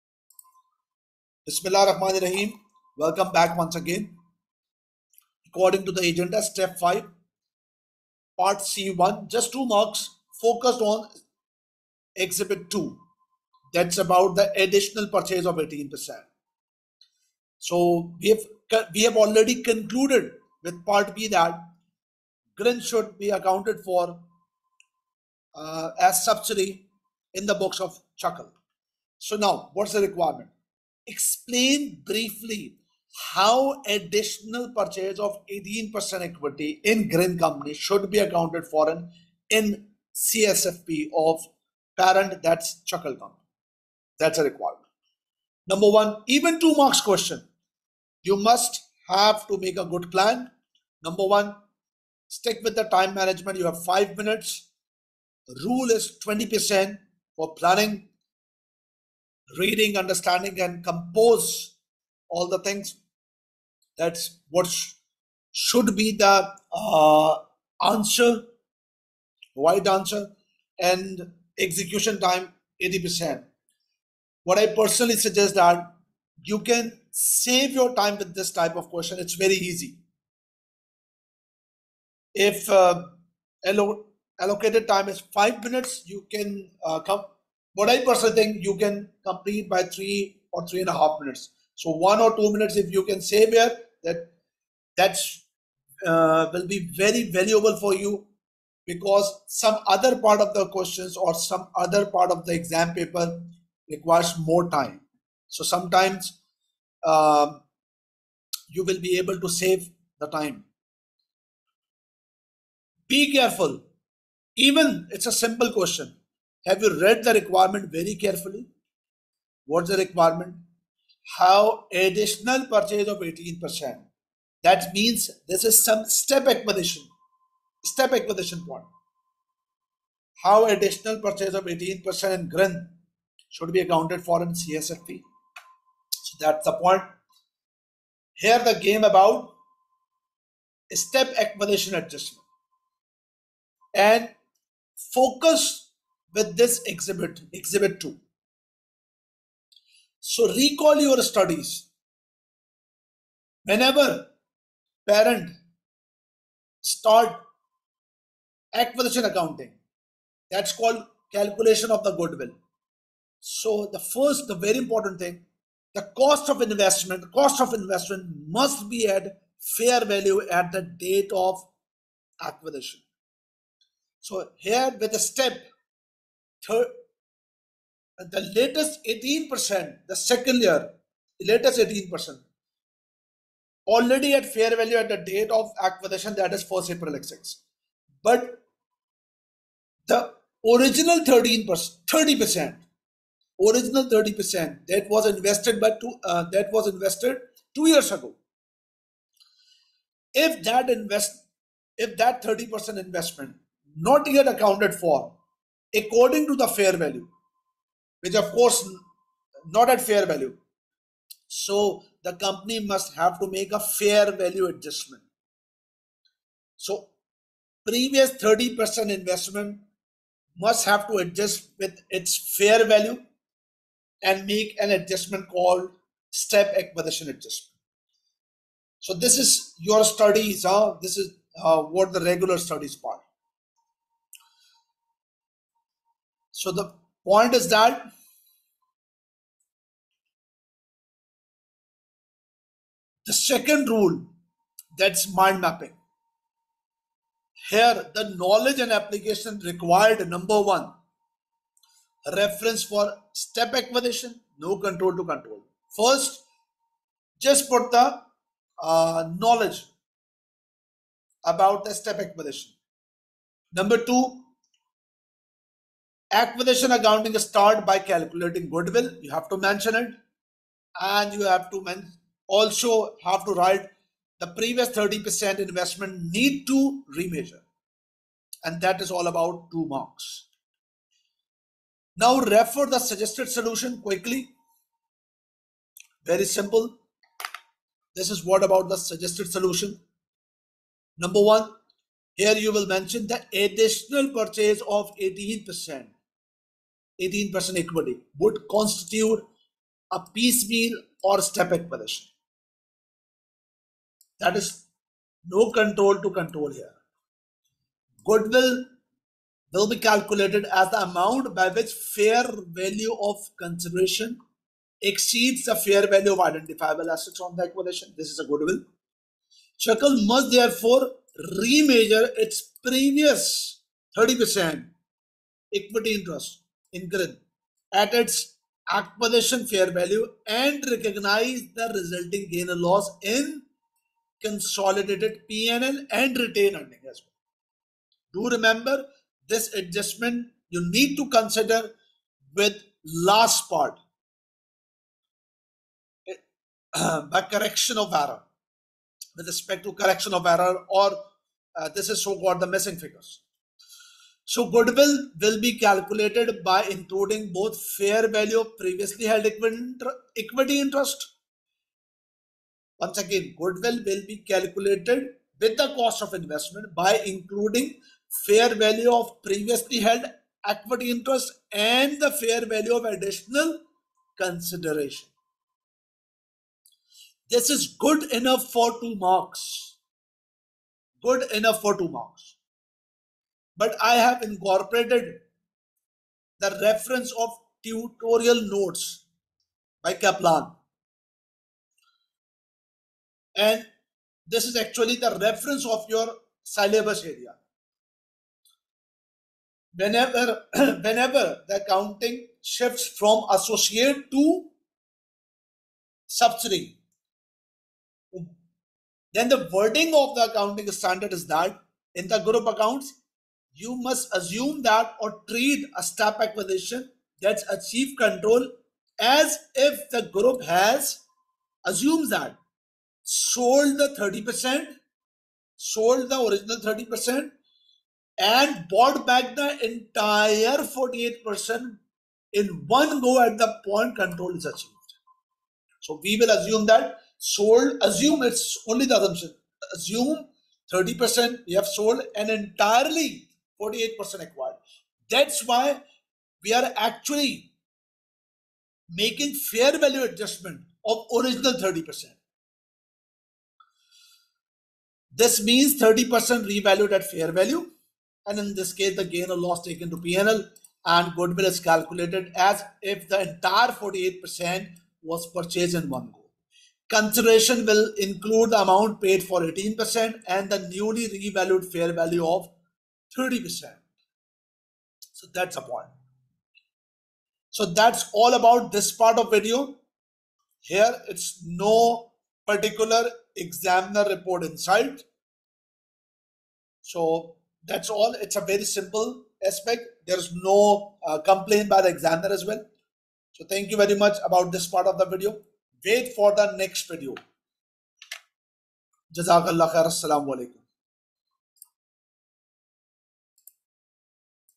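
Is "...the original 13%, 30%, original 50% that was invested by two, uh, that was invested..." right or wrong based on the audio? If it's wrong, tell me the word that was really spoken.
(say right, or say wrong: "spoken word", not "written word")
wrong: "30", not "50".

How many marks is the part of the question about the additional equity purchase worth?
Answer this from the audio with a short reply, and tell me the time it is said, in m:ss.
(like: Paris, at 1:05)
2, at 0:09.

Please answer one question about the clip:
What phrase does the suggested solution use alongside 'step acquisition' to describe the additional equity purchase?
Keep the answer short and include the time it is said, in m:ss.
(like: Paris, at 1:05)
piecemeal, at 5:00.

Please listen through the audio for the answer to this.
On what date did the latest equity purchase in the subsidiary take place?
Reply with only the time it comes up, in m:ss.
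3:06.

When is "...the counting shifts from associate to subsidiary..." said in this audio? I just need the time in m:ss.
6:41.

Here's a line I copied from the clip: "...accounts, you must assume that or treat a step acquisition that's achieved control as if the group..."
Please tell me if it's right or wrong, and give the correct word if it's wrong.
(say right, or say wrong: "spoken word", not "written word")
right.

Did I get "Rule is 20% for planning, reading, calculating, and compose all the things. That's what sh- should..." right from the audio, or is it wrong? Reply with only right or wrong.
wrong.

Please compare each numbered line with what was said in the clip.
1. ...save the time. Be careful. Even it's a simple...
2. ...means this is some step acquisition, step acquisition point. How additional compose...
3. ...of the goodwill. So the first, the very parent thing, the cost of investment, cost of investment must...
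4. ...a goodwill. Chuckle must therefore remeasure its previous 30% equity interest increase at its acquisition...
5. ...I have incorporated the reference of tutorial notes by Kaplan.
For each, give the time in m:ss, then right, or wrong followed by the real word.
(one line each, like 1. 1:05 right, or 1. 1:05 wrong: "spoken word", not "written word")
1. 1:49 right
2. 2:04 wrong: "purchase", not "compose"
3. 2:41 wrong: "important", not "parent"
4. 5:18 right
5. 6:24 right.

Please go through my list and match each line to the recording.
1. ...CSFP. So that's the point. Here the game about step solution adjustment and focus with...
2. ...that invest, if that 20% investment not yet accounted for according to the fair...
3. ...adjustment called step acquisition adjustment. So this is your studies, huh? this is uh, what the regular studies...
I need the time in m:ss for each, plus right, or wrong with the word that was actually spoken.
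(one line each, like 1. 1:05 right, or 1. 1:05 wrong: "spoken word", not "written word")
1. 2:14 wrong: "acquisition", not "solution"
2. 3:20 wrong: "30", not "20"
3. 3:44 right.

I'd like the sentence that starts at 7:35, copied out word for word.
This means 30% revalued at fair value.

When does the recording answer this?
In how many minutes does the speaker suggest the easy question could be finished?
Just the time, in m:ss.
1:29.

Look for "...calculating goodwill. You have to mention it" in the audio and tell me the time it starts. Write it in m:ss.
4:27.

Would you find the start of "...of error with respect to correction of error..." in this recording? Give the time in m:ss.
5:47.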